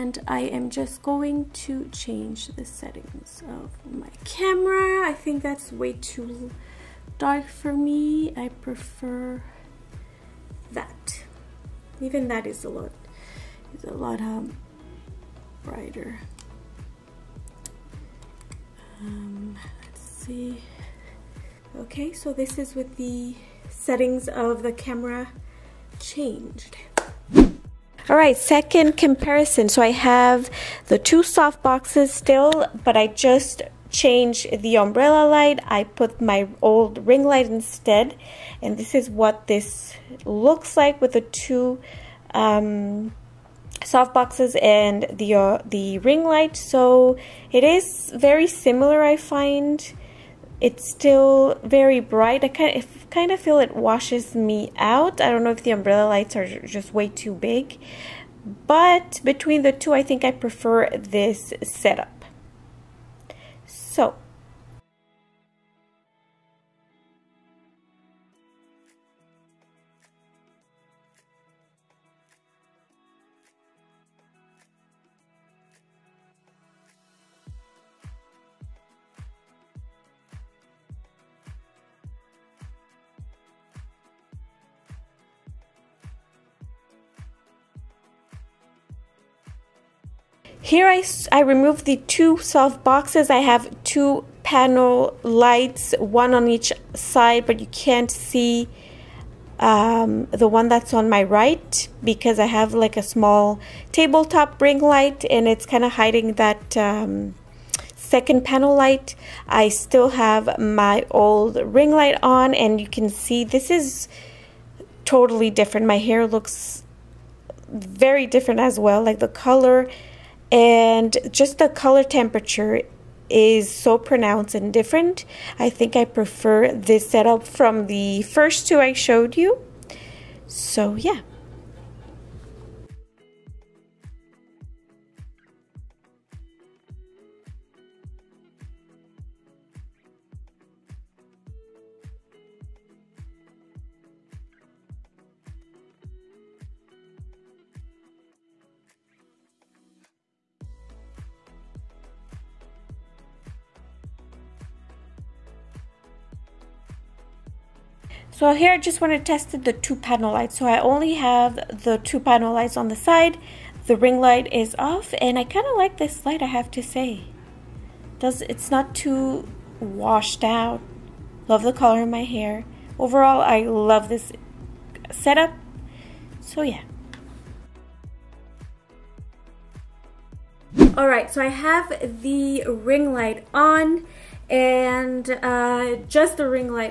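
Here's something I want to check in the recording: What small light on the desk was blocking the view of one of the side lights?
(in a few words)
tabletop ring light.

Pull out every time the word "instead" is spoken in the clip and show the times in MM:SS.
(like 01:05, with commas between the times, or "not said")
00:37.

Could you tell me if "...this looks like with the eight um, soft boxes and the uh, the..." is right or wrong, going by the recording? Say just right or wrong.
wrong.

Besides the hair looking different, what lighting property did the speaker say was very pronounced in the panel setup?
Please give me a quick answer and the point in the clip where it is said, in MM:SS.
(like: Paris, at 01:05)
color temperature, at 02:01.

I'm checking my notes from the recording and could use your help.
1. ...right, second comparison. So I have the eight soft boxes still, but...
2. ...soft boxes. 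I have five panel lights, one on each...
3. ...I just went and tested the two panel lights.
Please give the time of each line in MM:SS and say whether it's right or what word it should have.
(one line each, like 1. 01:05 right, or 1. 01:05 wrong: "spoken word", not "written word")
1. 00:28 wrong: "two", not "eight"
2. 01:32 wrong: "two", not "five"
3. 02:38 right.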